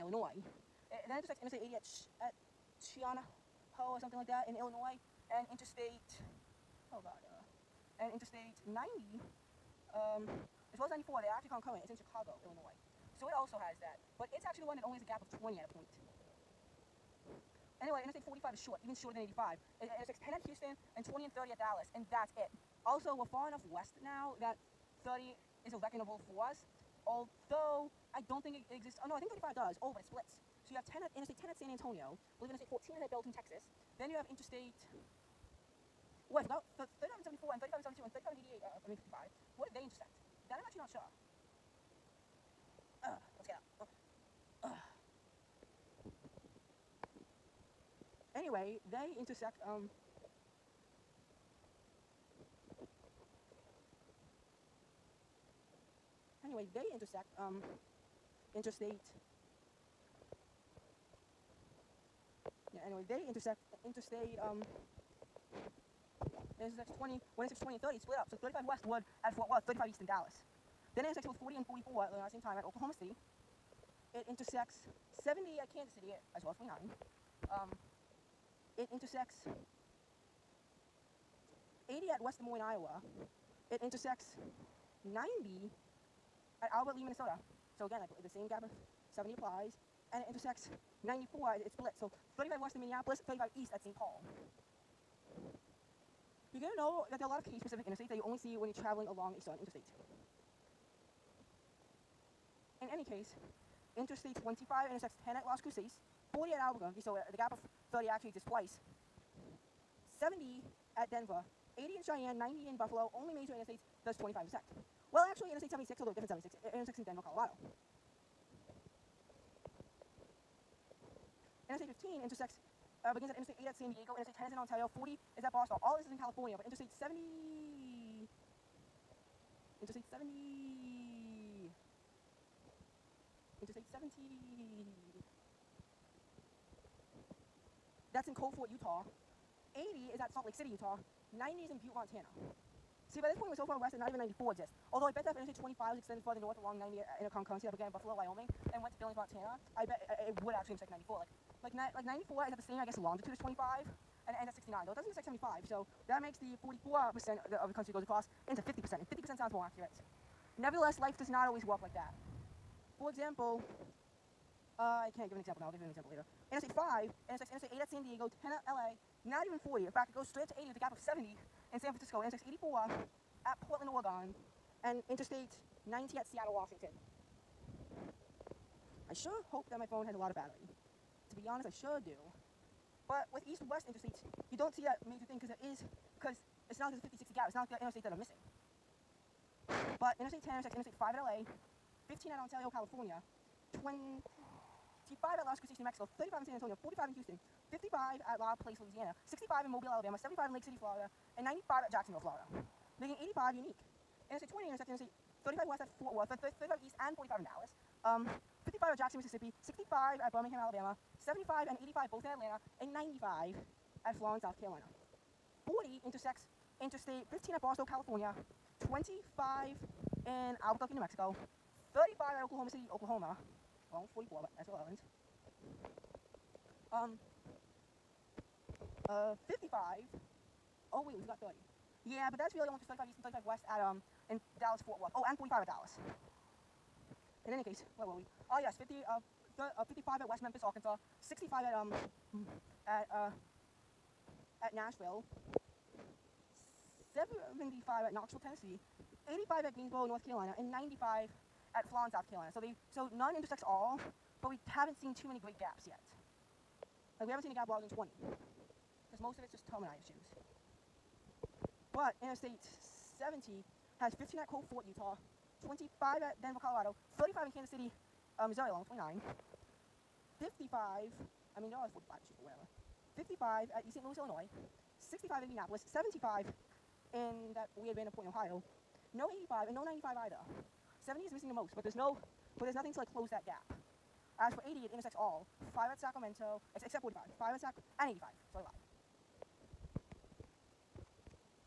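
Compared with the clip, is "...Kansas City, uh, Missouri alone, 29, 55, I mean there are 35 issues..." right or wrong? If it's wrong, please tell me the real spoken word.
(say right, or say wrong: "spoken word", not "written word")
wrong: "45", not "35".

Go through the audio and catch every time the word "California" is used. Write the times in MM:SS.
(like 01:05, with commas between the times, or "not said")
02:06, 03:12, 03:37.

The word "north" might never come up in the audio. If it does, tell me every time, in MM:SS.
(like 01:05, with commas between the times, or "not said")
02:26, 04:10.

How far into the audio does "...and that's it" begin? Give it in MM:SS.
00:21.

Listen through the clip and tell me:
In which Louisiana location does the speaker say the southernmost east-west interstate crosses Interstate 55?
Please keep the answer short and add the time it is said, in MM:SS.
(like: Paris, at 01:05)
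La Place, at 03:18.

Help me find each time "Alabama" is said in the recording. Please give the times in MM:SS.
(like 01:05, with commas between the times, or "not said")
03:19, 03:30.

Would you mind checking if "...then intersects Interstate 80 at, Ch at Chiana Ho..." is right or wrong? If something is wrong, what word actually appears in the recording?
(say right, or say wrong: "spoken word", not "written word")
right.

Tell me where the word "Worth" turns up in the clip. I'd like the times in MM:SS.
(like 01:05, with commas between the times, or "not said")
01:09, 03:26, 03:55.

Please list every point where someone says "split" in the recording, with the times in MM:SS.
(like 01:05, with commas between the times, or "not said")
00:30, 01:08, 01:31.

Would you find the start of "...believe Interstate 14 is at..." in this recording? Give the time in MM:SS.
00:32.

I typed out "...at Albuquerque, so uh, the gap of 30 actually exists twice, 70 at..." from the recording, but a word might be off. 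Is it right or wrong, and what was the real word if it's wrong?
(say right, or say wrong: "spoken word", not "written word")
right.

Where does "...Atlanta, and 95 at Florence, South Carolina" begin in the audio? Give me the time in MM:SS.
03:32.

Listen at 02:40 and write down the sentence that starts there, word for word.
Nevertheless, life does not always walk like that.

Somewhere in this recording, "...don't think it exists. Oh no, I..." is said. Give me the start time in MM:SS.
00:28.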